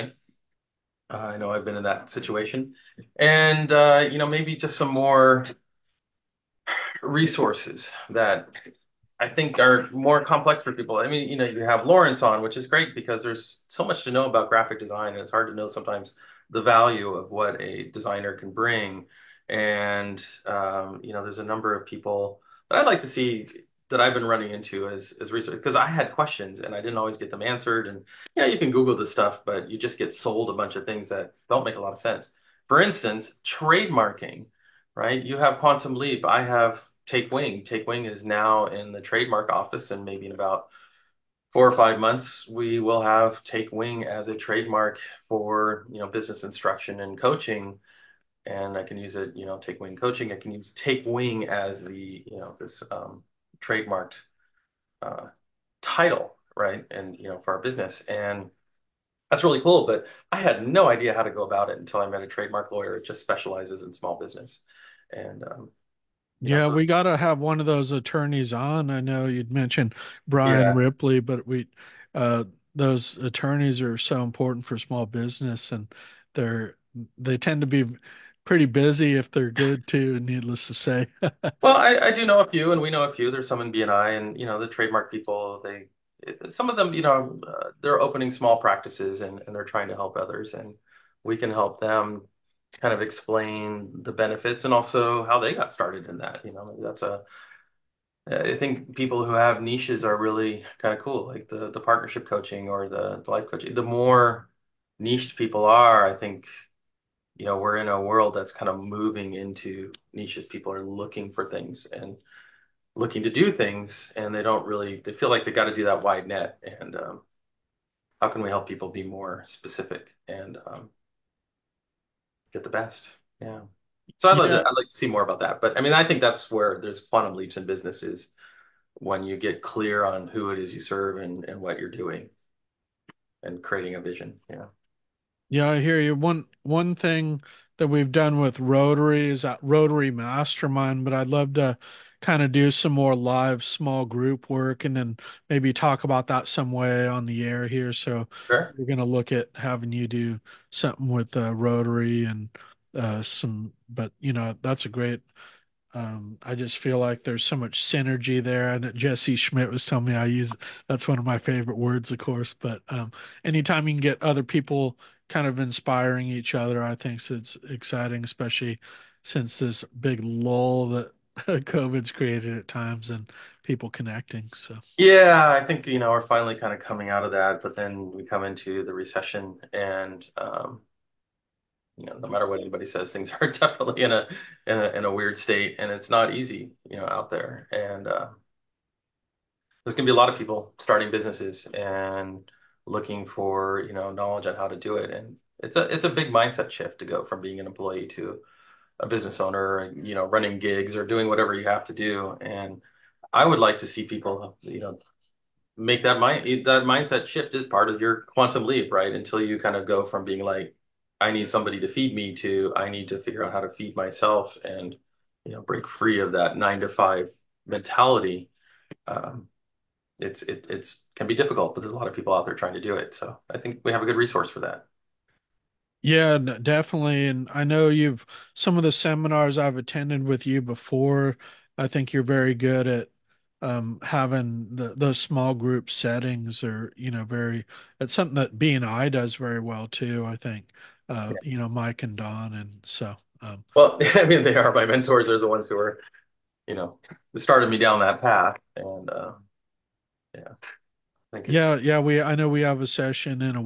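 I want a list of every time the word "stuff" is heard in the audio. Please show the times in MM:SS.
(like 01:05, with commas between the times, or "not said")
00:29.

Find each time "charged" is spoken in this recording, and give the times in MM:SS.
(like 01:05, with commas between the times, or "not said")
not said.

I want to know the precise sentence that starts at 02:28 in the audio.
we're going to look at having you do something with uh, Rotary and uh, some, but you know, that's a great.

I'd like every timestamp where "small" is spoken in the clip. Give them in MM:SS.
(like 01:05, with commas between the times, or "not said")
01:03, 01:14, 01:28, 02:23, 03:55.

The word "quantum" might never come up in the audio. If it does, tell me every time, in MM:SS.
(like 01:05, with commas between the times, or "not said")
00:35, 02:07, 03:28.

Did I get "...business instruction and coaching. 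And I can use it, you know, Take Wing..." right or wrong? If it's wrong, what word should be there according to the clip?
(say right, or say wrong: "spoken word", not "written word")
right.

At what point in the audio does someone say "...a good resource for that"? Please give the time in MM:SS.
03:44.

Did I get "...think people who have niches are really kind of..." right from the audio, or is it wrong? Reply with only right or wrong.
right.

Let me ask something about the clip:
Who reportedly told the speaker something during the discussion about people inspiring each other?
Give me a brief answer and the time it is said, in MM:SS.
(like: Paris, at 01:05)
Jesse Schmidt, at 02:38.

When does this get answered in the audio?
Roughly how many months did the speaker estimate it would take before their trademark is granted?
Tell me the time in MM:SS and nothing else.
00:41.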